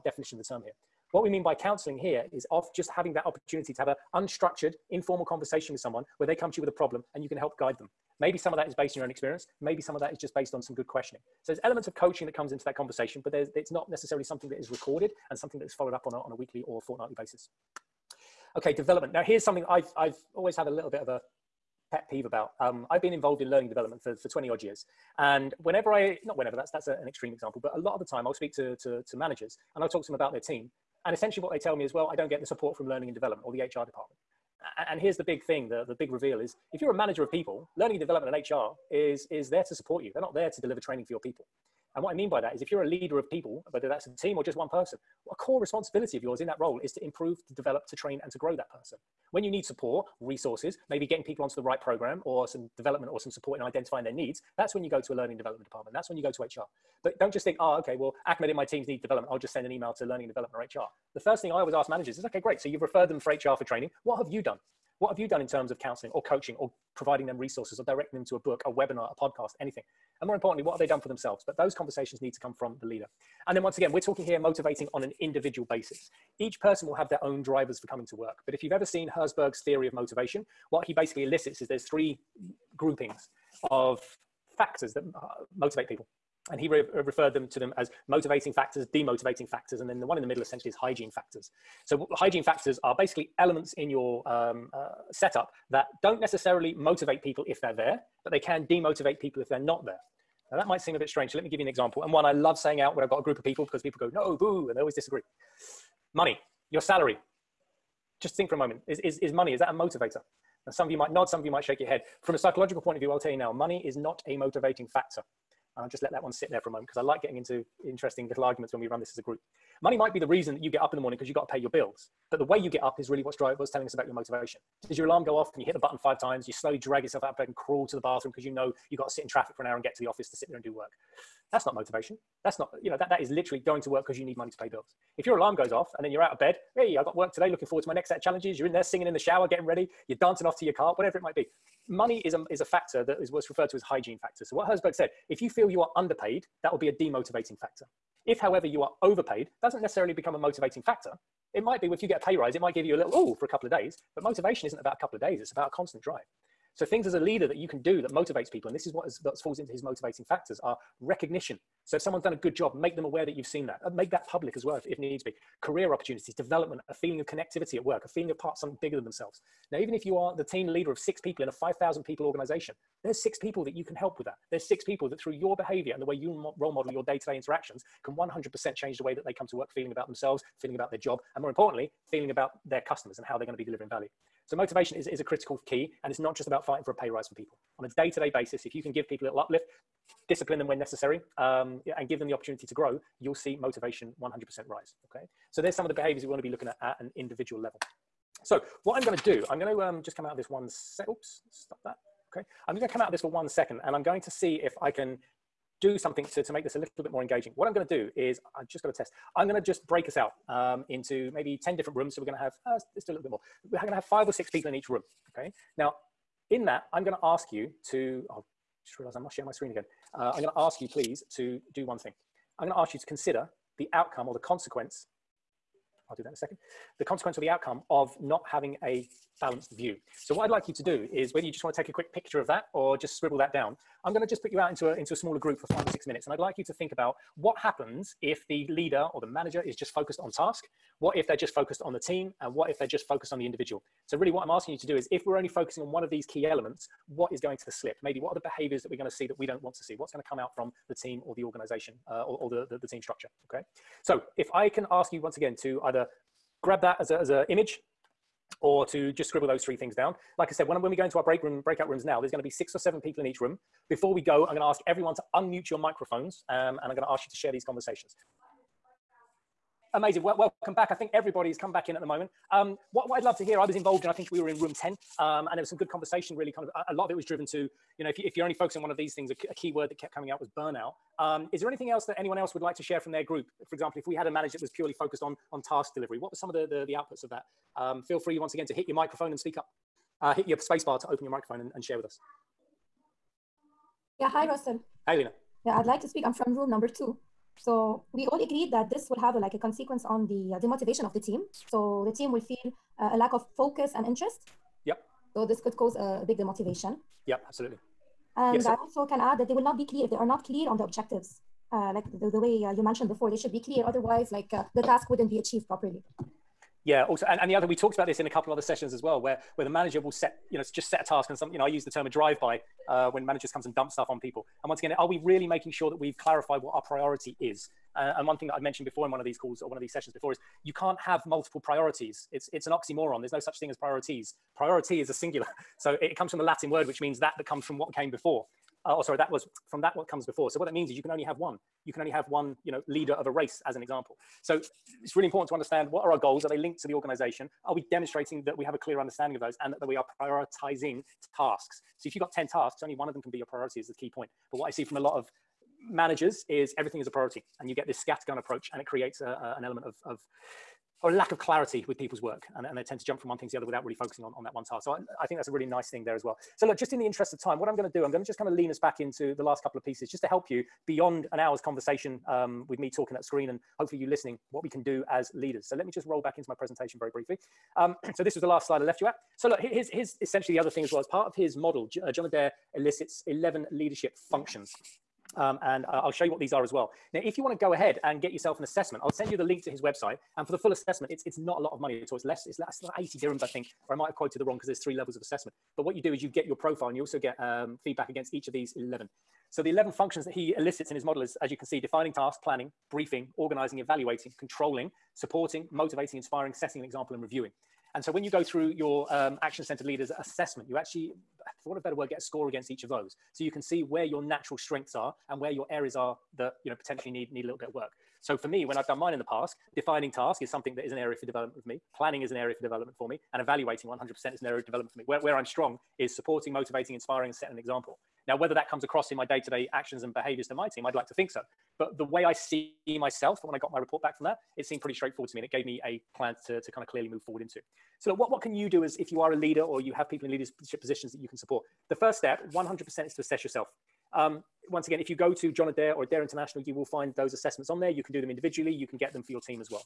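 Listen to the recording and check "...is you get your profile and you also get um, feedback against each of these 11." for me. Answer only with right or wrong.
right.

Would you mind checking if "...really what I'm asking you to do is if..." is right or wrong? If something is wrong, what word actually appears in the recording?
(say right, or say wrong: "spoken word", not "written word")
right.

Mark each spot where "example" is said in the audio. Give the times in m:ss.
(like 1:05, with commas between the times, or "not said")
0:27, 1:41, 4:43, 5:43, 6:46, 7:07.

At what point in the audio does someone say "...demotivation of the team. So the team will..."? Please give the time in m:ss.
5:00.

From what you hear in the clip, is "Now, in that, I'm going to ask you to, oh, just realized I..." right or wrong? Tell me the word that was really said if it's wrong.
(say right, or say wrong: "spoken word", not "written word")
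right.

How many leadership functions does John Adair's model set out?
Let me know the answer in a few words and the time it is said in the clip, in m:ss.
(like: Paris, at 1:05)
11, at 6:23.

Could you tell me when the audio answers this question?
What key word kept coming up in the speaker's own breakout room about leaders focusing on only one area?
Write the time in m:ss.
4:40.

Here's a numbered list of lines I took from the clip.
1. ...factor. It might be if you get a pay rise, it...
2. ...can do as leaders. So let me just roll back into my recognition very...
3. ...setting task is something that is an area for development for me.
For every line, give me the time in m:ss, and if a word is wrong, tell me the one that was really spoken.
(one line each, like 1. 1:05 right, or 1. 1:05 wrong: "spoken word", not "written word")
1. 2:30 right
2. 6:14 wrong: "presentation", not "recognition"
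3. 6:59 wrong: "defining", not "setting".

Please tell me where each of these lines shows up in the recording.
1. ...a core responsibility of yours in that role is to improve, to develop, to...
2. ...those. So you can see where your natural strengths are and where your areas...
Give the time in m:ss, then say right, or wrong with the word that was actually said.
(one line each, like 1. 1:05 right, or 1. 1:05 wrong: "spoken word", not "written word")
1. 0:45 right
2. 6:52 right.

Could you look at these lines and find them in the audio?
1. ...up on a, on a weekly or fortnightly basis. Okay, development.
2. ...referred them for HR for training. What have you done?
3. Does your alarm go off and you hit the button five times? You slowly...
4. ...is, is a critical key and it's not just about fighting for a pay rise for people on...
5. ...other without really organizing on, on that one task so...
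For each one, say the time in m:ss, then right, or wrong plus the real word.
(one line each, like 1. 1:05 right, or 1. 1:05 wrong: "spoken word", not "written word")
1. 0:15 right
2. 1:02 right
3. 2:04 right
4. 3:04 right
5. 6:03 wrong: "focusing", not "organizing".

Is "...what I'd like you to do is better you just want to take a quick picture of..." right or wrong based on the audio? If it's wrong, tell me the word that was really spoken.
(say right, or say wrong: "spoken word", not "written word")
wrong: "whether", not "better".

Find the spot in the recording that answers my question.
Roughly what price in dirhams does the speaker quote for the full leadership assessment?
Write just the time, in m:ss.
6:32.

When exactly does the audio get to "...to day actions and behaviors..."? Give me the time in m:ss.
7:09.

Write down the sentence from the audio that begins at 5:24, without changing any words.
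And once again, are we really making sure that we've clarified what our priority is?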